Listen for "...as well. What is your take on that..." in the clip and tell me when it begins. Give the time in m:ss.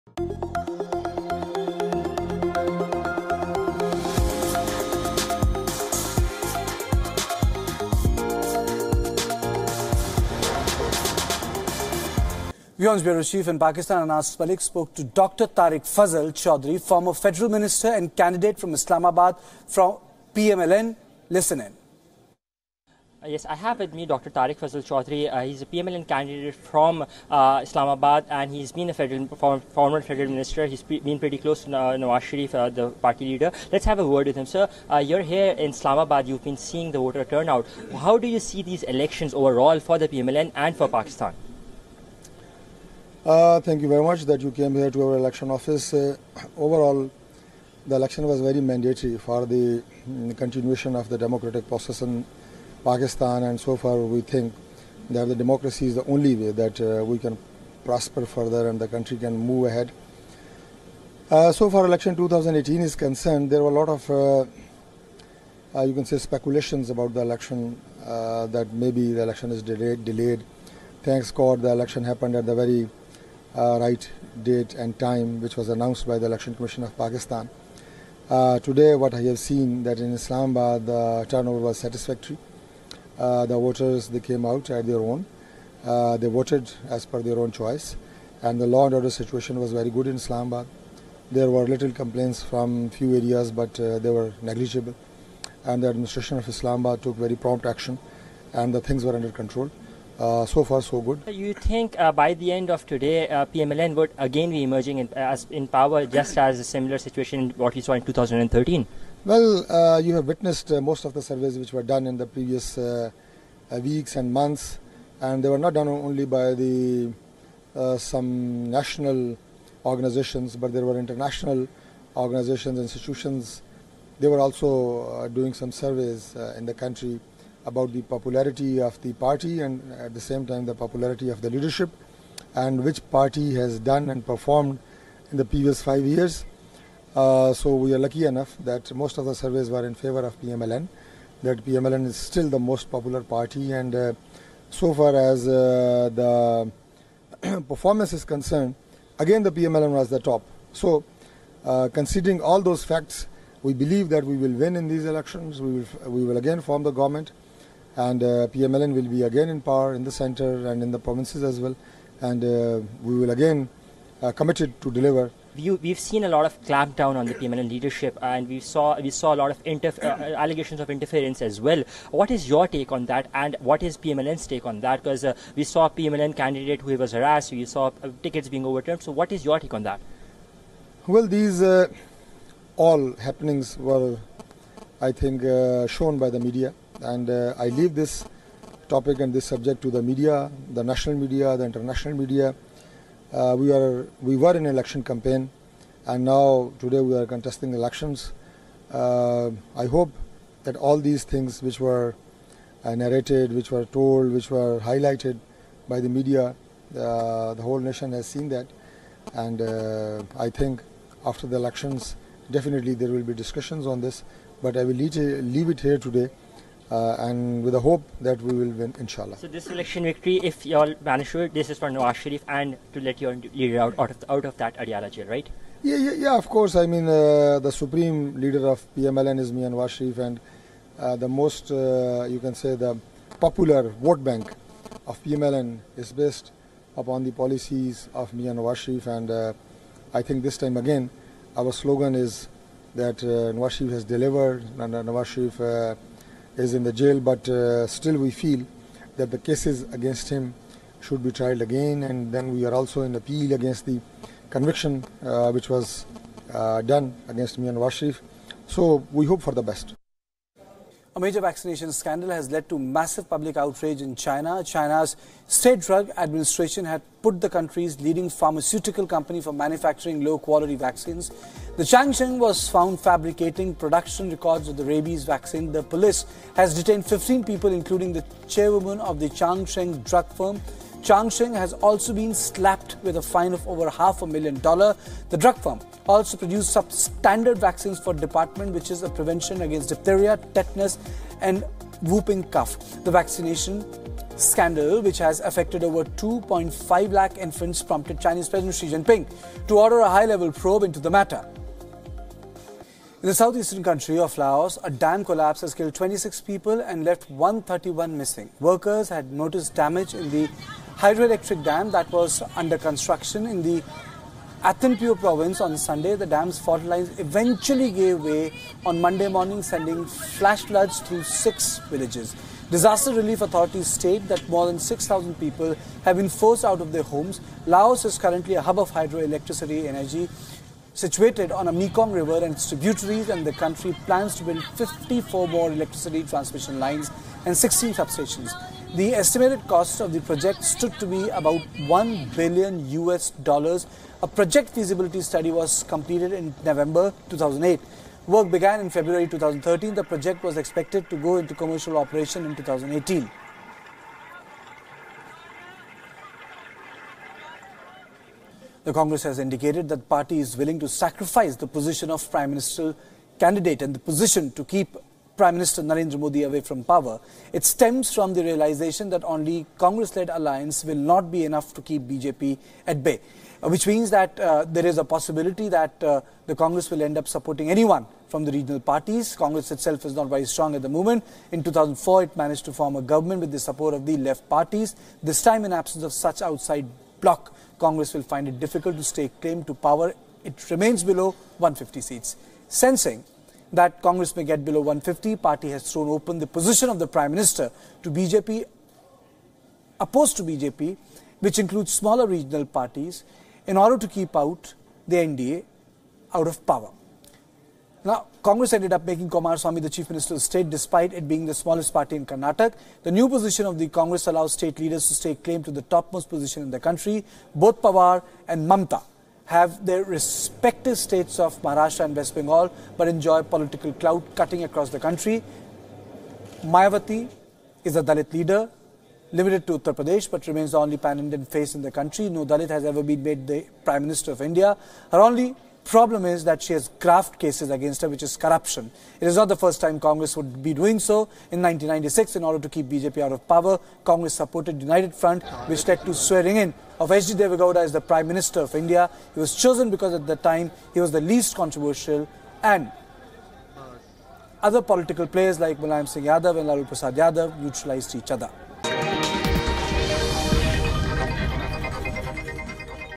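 2:51.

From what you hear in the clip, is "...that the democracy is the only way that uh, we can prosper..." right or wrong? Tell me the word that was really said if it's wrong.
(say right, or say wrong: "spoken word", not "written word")
right.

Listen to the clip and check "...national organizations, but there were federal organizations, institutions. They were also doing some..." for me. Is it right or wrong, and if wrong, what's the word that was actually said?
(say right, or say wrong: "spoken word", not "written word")
wrong: "international", not "federal".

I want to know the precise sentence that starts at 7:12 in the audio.
No Dalit has ever been made the Prime Minister of India.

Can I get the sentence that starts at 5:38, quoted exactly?
The estimated cost of the project stood to be about 1 billion US dollars.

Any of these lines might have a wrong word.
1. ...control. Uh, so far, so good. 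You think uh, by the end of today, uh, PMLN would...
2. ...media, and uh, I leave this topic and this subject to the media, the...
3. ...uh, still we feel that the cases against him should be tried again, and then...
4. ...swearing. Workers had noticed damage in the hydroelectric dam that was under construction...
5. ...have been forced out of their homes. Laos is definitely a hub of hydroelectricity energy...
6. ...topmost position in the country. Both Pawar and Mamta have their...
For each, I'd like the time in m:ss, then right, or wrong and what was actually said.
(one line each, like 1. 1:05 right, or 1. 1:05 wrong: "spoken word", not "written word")
1. 1:39 right
2. 3:06 right
3. 4:07 right
4. 5:08 wrong: "missing", not "swearing"
5. 5:26 wrong: "currently", not "definitely"
6. 6:55 right.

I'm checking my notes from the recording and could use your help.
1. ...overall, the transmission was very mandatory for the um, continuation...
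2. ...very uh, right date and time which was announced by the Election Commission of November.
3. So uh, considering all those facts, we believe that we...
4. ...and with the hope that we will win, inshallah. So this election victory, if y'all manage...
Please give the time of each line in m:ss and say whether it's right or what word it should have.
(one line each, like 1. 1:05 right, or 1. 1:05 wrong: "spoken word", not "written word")
1. 0:46 wrong: "election", not "transmission"
2. 1:12 wrong: "Pakistan", not "November"
3. 2:30 right
4. 3:37 right.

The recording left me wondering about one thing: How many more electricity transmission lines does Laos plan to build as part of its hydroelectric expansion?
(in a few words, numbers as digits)
54.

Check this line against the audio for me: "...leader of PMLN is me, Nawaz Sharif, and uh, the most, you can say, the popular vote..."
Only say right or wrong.
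right.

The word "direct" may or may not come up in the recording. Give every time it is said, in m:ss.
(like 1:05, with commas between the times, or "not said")
not said.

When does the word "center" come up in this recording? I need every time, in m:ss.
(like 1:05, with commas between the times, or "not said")
2:40.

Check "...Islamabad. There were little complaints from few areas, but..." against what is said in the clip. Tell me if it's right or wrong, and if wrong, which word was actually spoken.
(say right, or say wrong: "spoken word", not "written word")
right.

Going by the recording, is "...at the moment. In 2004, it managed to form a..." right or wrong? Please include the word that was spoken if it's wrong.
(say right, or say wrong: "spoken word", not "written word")
right.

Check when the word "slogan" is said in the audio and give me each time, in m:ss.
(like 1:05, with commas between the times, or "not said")
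4:01.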